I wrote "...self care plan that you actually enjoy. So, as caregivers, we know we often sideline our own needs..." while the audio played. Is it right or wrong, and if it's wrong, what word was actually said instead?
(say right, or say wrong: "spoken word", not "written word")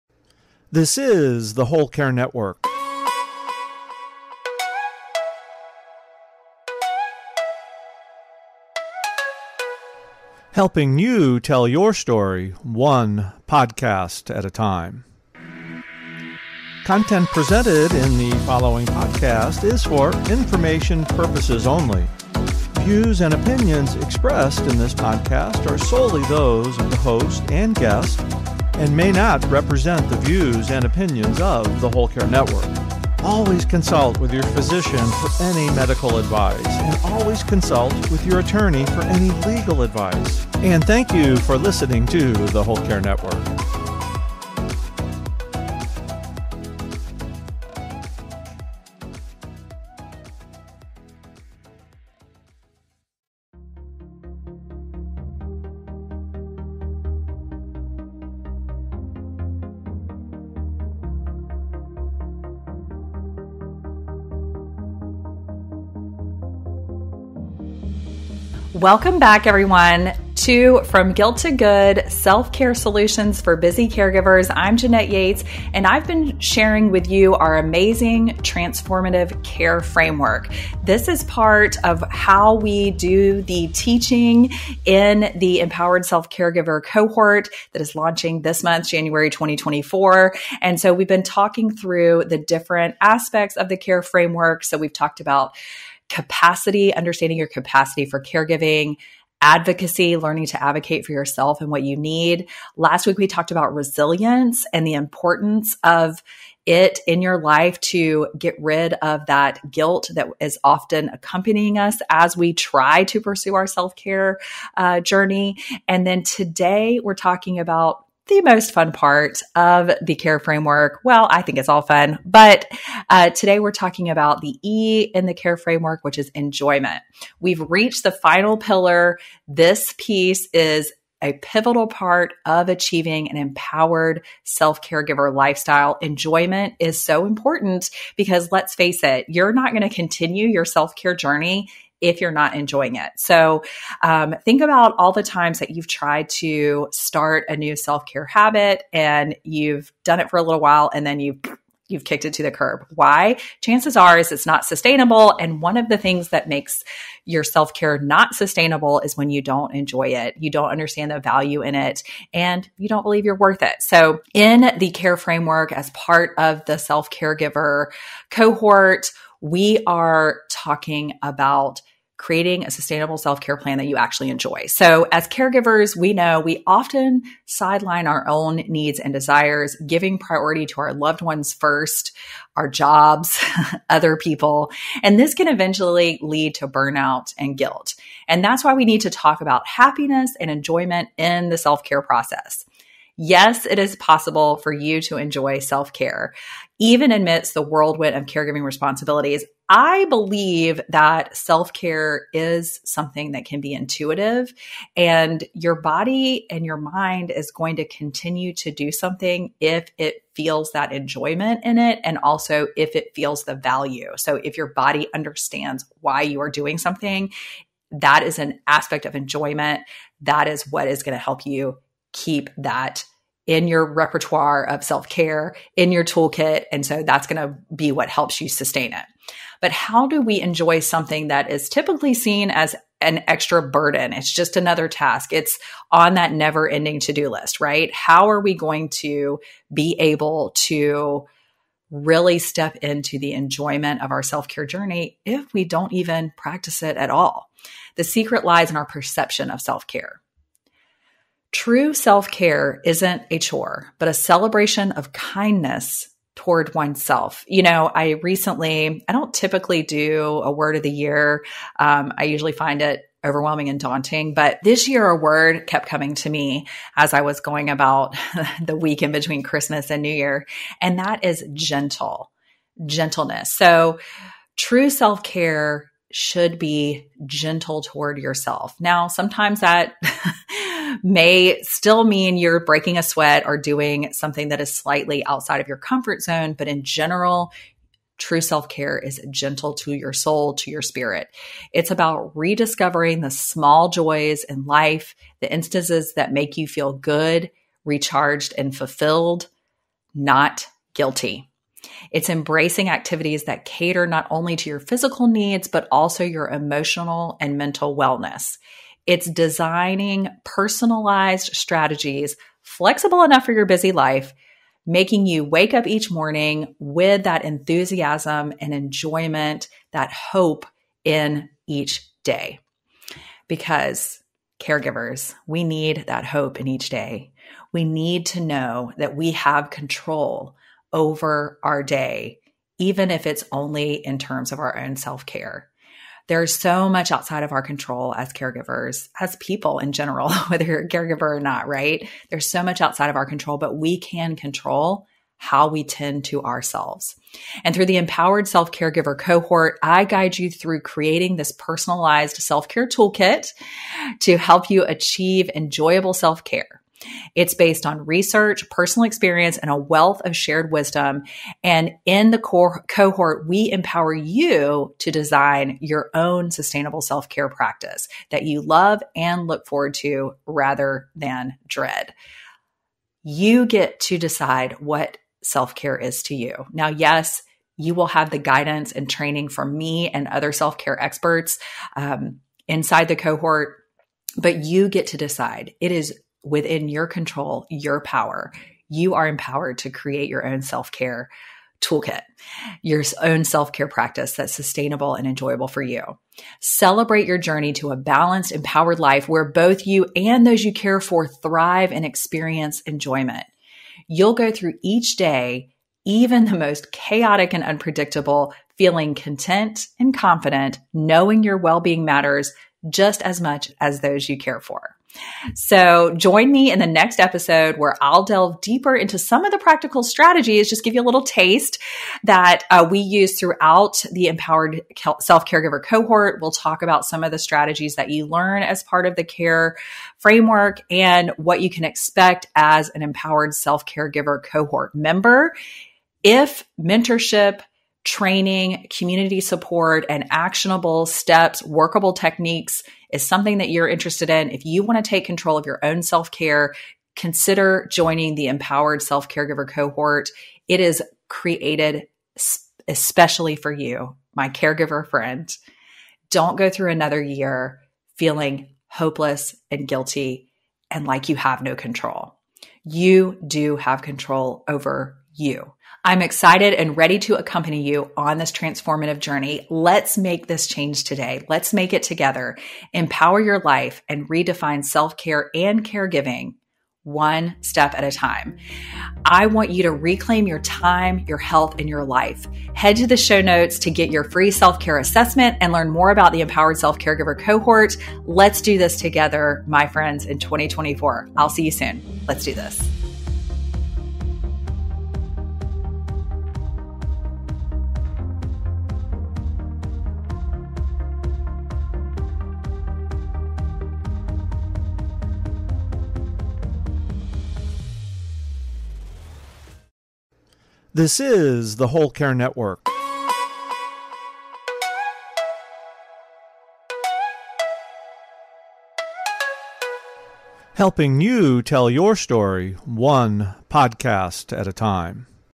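right.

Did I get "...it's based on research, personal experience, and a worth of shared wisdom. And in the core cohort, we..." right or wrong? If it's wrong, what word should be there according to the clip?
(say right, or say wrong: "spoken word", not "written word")
wrong: "wealth", not "worth".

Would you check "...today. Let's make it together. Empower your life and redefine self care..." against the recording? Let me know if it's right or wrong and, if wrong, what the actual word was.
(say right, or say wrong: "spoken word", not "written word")
right.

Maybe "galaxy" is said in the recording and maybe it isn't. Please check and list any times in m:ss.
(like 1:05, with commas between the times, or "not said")
not said.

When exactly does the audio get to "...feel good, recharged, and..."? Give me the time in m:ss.
4:56.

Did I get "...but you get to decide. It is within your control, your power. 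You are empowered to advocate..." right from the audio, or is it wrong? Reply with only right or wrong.
wrong.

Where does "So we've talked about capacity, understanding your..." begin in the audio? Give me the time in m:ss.
1:34.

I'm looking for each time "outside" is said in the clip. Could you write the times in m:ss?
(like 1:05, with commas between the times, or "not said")
4:45, 5:37, 5:42.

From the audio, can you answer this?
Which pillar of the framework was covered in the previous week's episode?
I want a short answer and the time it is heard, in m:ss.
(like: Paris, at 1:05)
Resilience, at 1:43.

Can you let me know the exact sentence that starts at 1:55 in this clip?
And then today, we're talking about the most fun part of the care framework.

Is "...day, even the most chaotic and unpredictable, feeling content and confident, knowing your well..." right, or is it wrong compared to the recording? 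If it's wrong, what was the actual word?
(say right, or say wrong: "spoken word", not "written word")
right.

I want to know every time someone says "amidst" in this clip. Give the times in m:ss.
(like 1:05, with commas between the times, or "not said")
3:17.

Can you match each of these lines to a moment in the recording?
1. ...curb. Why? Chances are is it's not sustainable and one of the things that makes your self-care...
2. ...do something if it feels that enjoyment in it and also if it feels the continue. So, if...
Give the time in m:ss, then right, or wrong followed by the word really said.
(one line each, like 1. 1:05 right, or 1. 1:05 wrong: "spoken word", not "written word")
1. 2:32 right
2. 3:28 wrong: "value", not "continue".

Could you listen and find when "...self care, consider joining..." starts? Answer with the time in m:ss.
7:26.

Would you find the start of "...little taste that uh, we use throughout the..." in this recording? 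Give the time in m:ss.
7:01.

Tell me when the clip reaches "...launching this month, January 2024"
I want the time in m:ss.
1:27.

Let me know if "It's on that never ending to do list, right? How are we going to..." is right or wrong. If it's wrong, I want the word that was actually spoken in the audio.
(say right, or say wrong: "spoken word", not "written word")
right.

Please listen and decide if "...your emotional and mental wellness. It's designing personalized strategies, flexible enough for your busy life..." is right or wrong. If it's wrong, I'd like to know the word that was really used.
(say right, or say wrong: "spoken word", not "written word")
right.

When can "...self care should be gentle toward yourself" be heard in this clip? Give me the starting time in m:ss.
4:34.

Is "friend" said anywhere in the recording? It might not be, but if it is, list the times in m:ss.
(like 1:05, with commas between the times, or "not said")
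7:35, 8:09.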